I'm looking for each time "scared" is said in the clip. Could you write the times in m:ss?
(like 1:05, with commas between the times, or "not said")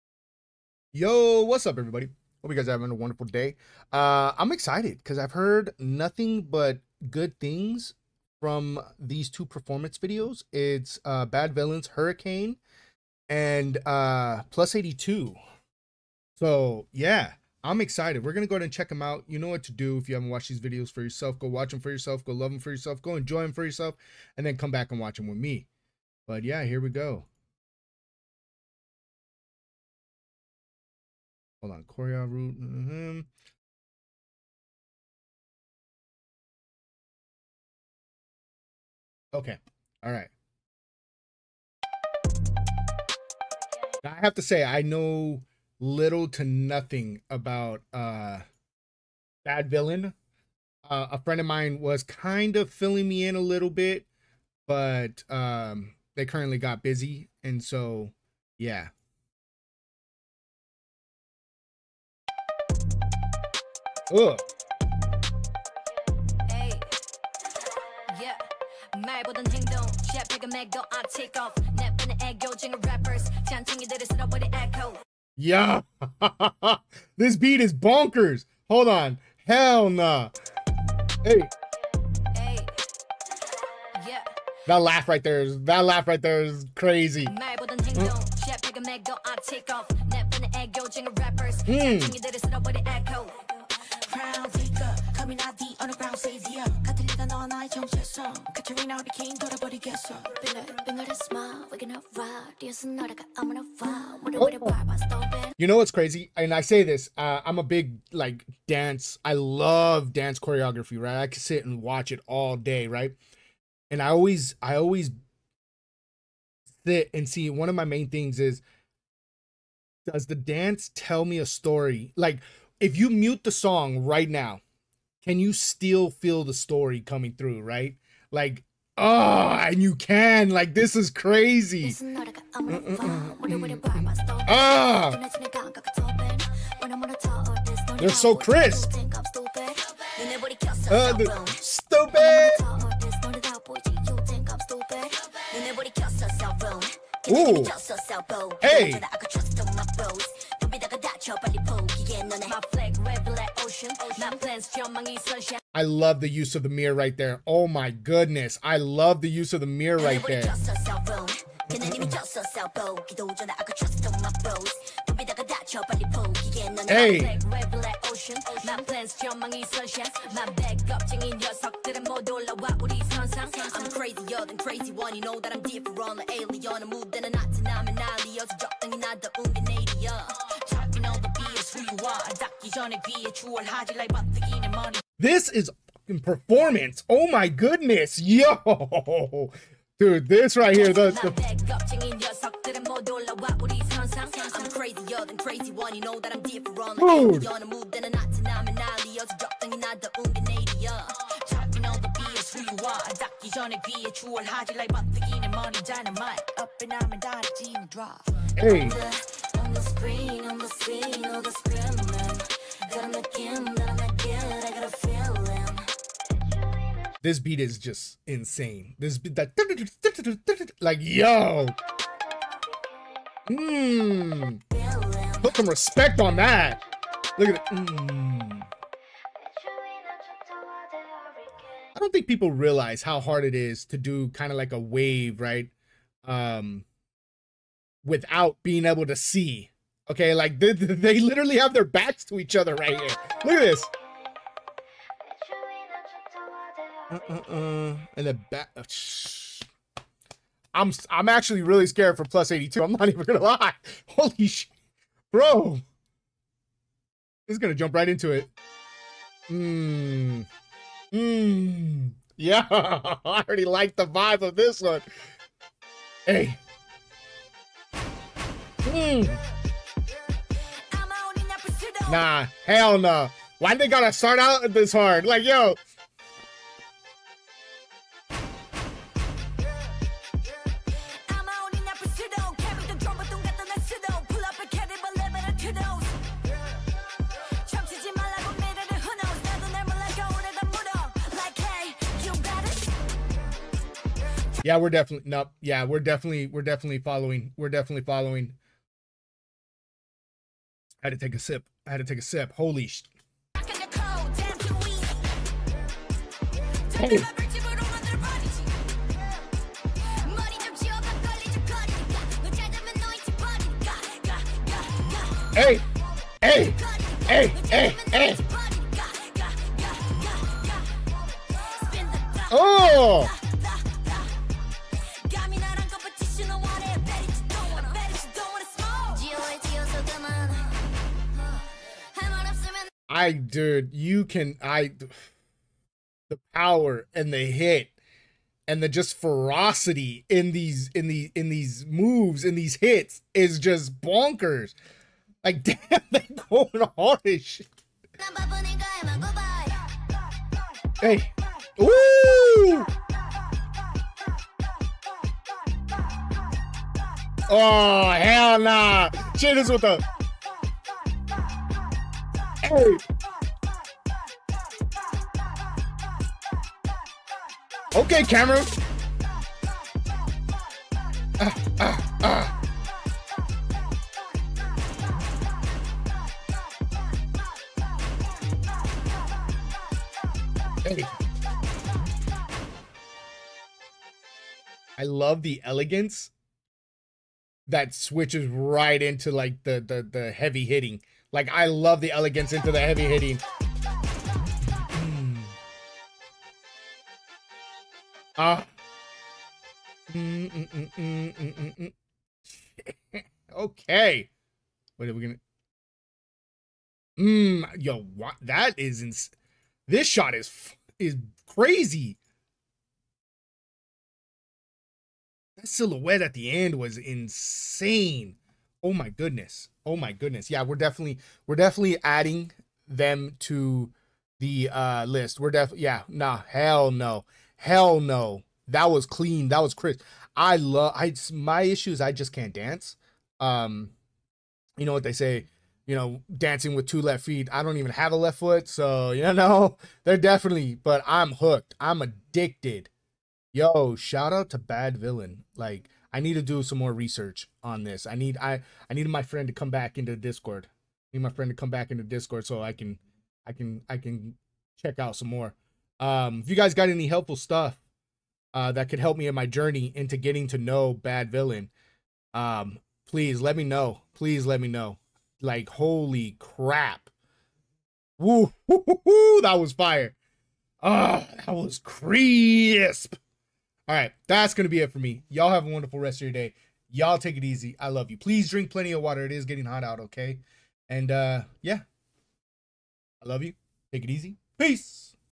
4:11.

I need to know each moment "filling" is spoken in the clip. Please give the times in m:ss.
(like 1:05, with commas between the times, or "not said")
0:52.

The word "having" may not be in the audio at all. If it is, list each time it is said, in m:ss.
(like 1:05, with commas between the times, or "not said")
0:02.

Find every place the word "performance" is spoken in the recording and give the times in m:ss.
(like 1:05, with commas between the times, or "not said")
0:09.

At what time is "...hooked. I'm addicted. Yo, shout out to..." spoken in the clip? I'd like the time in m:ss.
7:21.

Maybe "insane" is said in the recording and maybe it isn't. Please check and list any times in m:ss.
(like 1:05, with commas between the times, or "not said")
3:38, 6:56.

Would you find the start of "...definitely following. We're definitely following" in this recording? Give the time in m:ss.
4:56.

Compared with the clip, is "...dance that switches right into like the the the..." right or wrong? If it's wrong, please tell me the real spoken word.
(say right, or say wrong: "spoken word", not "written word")
wrong: "elegance", not "dance".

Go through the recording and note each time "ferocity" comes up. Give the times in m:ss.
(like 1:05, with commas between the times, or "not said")
5:39.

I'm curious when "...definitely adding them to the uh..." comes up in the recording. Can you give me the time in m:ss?
7:01.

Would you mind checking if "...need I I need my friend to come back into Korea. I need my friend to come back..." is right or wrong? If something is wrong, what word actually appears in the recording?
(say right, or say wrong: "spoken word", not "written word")
wrong: "Discord", not "Korea".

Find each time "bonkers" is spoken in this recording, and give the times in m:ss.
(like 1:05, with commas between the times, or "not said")
1:17, 5:44.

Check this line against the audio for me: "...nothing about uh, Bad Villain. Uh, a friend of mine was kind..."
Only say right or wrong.
right.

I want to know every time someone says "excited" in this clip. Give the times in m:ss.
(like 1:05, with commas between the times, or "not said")
0:04, 0:17.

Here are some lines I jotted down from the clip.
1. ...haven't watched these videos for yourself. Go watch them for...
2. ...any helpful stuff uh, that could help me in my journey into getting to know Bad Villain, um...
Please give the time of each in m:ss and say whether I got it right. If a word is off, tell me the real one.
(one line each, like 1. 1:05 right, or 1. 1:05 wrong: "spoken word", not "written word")
1. 0:20 right
2. 7:36 right.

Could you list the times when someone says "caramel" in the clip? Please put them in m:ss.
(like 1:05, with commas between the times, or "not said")
not said.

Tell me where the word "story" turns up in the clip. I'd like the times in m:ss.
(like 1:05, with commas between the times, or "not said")
2:01, 2:06.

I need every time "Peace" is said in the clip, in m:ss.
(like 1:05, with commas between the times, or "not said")
8:04.